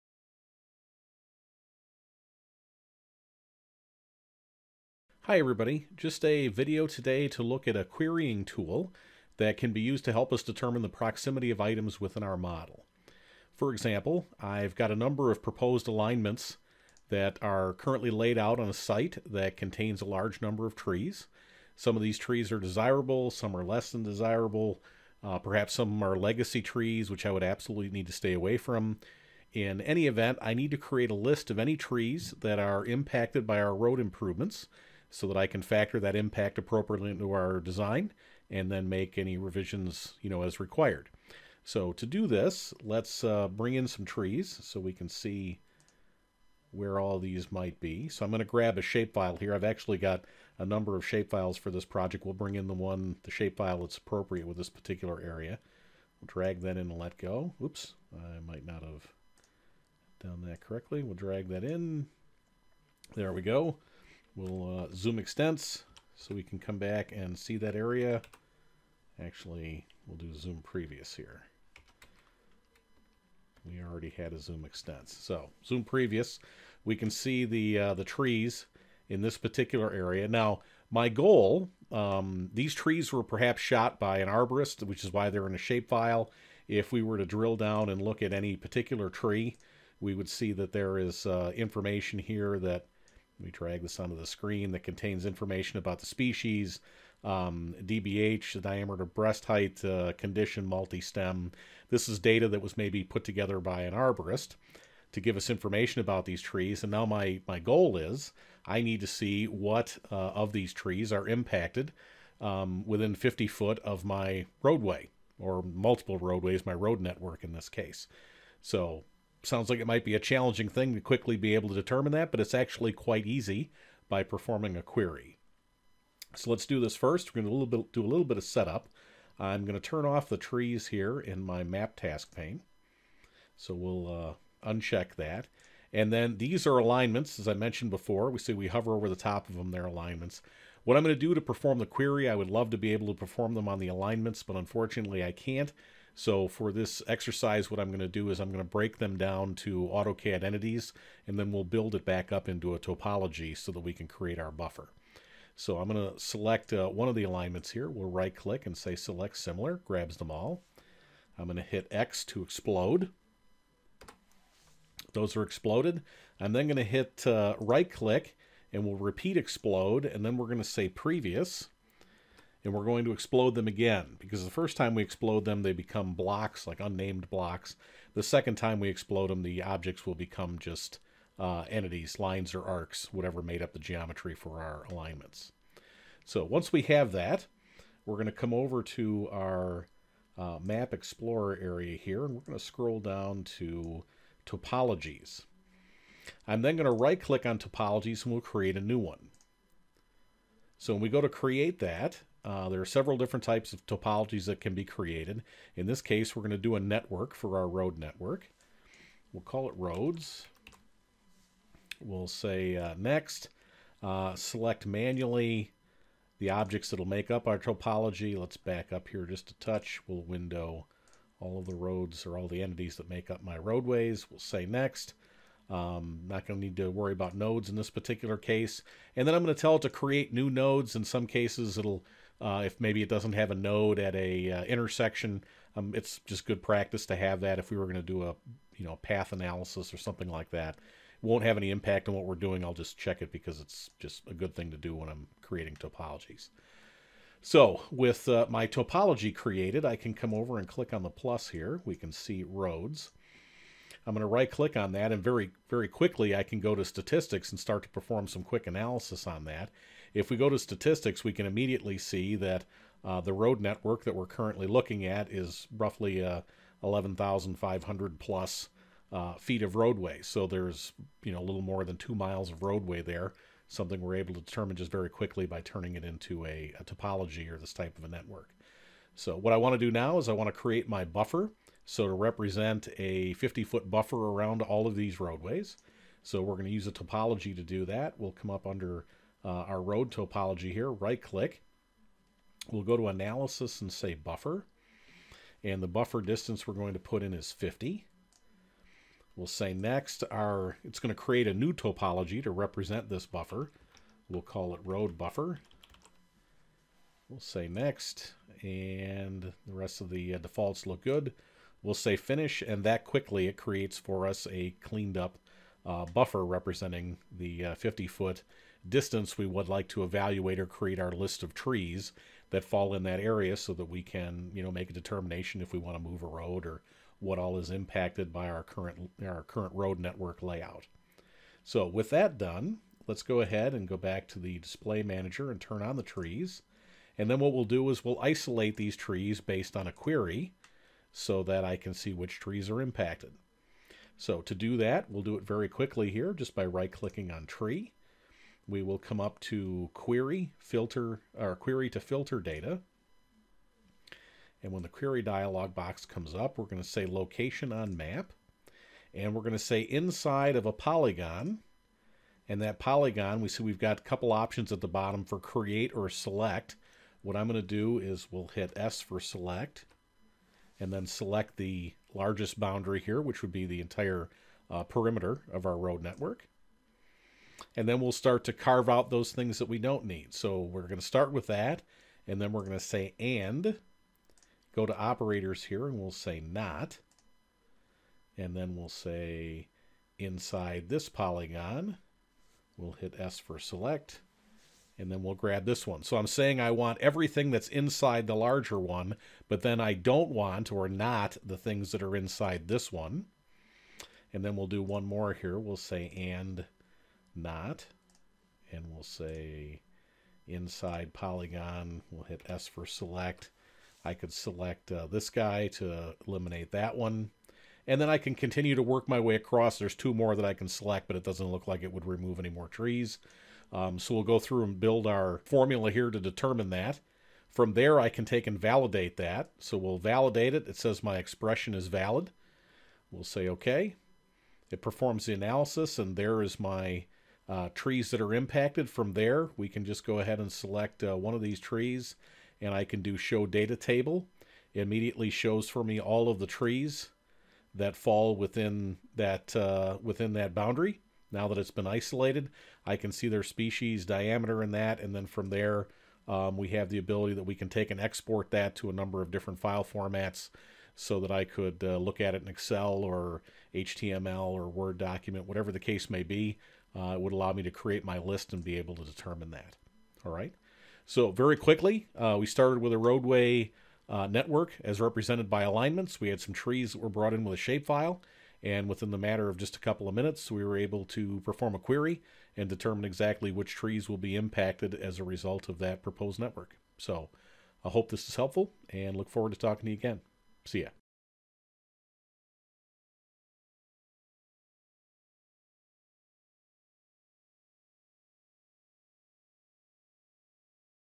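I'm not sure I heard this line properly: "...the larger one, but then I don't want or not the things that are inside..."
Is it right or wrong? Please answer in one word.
right.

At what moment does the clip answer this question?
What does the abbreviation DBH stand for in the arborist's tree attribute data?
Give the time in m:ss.
1:38.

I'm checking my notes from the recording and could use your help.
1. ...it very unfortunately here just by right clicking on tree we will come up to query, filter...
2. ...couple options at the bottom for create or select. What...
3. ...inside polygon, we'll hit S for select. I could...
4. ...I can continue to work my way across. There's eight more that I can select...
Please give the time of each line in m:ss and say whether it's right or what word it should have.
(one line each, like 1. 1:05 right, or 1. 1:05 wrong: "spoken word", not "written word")
1. 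5:45 wrong: "quickly", not "unfortunately"
2. 6:04 right
3. 6:50 right
4. 6:58 wrong: "two", not "eight".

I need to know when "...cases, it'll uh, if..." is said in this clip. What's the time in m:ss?
3:51.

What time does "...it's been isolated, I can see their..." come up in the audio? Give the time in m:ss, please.
7:31.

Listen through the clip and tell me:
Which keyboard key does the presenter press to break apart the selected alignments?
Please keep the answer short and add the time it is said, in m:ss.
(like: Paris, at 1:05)
X, at 2:41.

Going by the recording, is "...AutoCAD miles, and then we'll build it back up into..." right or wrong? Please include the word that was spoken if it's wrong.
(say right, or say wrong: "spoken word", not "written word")
wrong: "entities", not "miles".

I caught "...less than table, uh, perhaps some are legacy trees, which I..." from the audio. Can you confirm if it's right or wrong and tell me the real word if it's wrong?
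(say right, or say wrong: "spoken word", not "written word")
wrong: "desirable", not "table".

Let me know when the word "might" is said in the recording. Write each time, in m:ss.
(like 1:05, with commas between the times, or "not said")
0:47, 0:58, 1:59.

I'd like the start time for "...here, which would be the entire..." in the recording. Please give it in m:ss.
6:12.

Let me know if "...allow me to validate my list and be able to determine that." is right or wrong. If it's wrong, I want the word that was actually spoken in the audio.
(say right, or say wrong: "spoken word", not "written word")
wrong: "create", not "validate".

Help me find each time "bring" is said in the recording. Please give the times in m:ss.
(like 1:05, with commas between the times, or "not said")
0:43, 0:52.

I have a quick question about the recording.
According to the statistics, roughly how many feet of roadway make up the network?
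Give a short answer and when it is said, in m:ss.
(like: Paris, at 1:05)
11,500, at 4:26.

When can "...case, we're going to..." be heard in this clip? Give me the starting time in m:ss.
3:26.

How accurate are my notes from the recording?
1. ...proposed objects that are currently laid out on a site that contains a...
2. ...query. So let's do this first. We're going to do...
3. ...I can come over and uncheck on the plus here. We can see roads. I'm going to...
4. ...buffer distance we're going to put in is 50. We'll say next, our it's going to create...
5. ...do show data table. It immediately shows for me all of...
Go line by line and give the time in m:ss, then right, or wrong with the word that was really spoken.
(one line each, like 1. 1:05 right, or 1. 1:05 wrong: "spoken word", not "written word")
1. 0:15 wrong: "alignments", not "objects"
2. 2:04 right
3. 4:09 wrong: "click", not "uncheck"
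4. 4:55 right
5. 7:23 right.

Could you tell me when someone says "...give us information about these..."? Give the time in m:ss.
1:45.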